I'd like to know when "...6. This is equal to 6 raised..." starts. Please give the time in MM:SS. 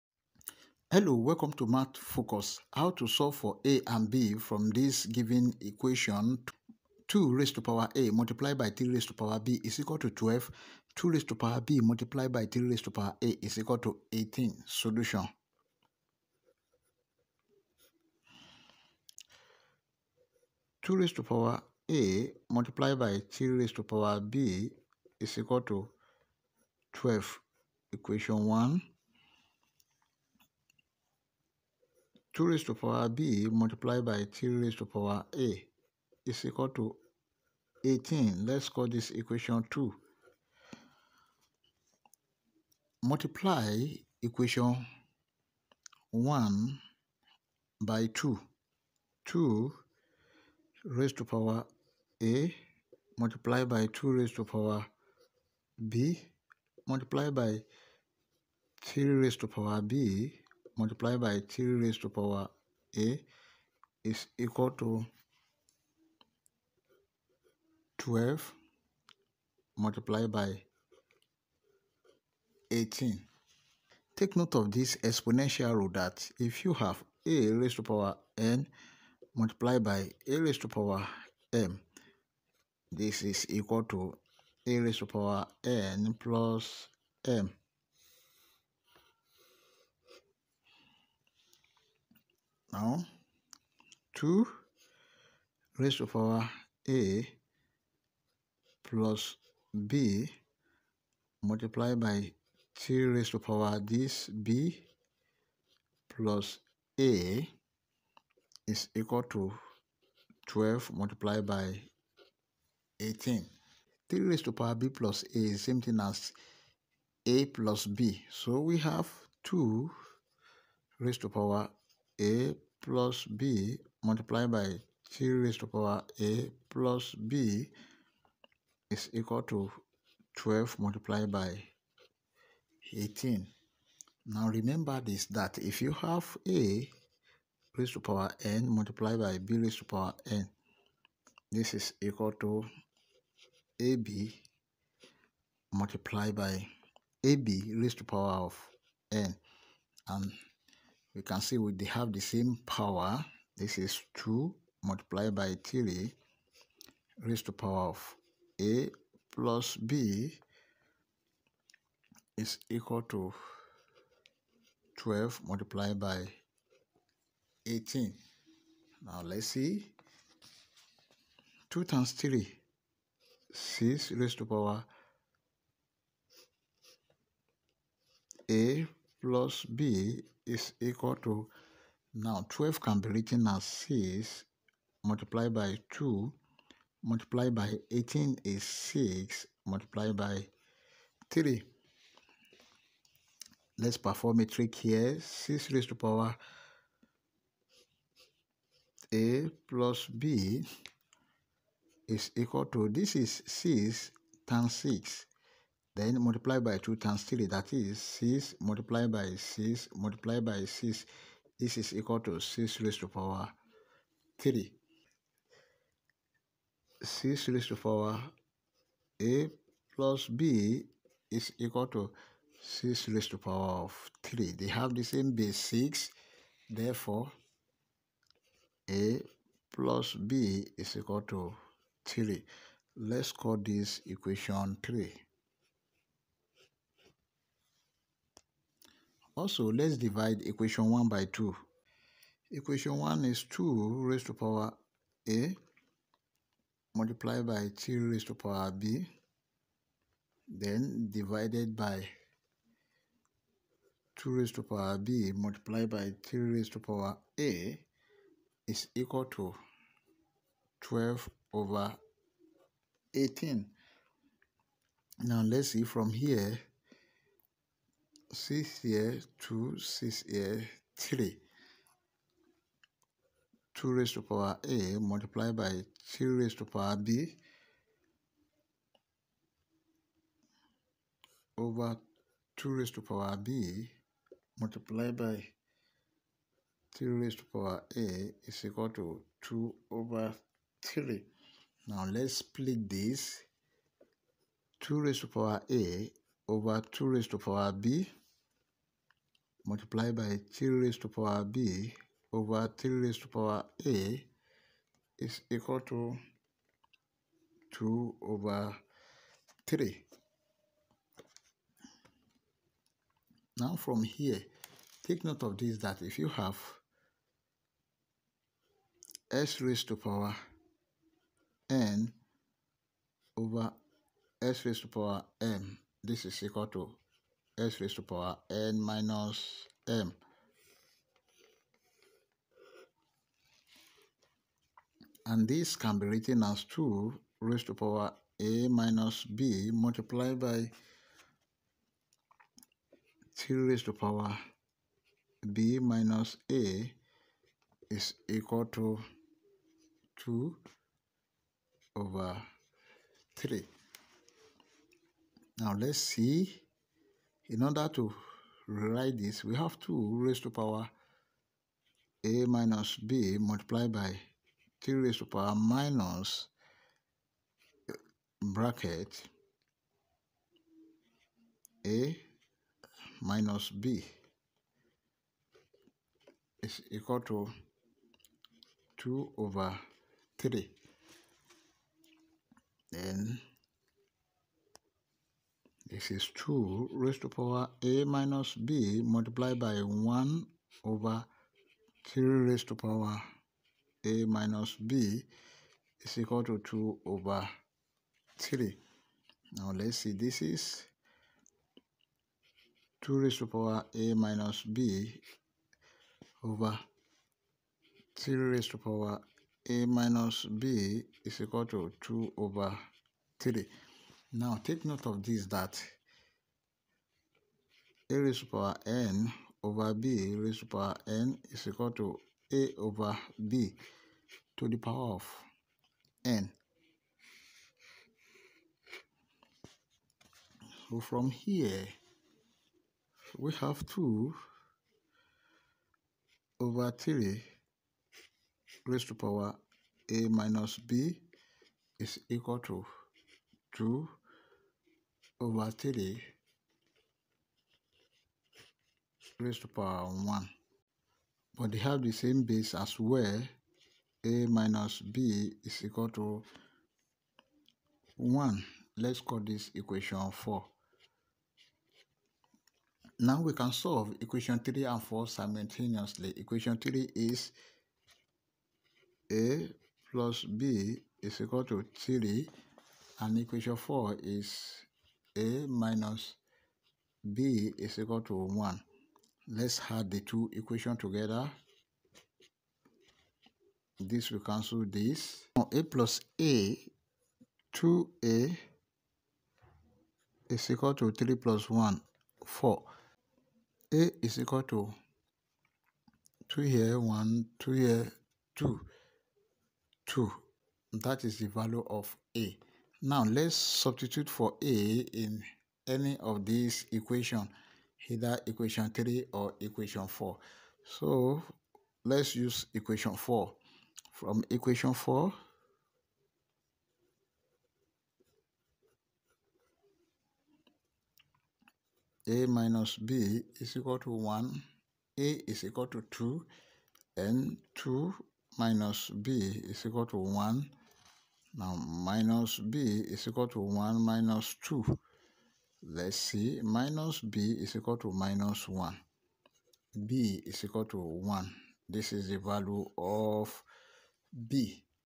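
03:30.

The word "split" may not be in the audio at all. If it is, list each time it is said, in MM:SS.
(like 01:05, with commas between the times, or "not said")
04:52.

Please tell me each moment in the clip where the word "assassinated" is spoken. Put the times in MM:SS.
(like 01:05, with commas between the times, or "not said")
not said.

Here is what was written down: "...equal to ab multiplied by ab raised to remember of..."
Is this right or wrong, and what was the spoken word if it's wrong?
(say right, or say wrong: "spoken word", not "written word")
wrong: "power", not "remember".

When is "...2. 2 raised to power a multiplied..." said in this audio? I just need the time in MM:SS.
00:48.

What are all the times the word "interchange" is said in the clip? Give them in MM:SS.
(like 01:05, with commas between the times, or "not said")
not said.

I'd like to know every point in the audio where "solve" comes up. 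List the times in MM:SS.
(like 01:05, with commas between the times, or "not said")
00:03, 07:43.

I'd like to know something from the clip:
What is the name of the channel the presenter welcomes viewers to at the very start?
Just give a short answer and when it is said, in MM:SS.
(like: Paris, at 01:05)
Math Focus, at 00:01.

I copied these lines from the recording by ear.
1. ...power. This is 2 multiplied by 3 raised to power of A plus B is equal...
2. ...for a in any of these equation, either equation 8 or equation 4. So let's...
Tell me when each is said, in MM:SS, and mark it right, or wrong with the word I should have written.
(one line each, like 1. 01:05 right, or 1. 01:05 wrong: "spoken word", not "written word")
1. 02:32 right
2. 08:24 wrong: "3", not "8".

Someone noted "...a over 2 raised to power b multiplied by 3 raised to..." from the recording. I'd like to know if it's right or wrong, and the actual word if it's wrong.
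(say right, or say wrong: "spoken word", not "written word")
right.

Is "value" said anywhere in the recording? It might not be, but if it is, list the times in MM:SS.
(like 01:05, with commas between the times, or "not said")
08:21, 09:02.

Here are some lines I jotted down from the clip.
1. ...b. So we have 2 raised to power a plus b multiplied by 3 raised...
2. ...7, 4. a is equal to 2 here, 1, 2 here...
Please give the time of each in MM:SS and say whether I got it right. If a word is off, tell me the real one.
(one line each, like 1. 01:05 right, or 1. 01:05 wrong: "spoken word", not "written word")
1. 01:57 right
2. 08:11 wrong: "1", not "7".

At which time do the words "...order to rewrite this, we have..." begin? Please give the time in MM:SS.
05:57.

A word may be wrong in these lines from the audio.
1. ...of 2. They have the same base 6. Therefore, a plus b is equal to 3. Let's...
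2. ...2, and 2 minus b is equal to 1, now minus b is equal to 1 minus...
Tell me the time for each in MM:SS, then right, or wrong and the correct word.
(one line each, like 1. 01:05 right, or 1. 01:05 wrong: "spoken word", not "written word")
1. 03:43 wrong: "3", not "2"
2. 08:46 right.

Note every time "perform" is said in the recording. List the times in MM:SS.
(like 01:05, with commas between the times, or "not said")
03:13.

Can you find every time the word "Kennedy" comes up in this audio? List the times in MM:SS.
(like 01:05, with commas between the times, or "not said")
not said.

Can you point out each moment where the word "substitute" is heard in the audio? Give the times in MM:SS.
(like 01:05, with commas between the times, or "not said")
08:23.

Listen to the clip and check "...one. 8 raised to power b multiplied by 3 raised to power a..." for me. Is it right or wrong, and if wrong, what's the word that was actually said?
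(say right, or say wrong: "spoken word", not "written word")
wrong: "2", not "8".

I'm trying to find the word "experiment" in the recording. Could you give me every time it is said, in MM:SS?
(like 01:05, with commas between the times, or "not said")
not said.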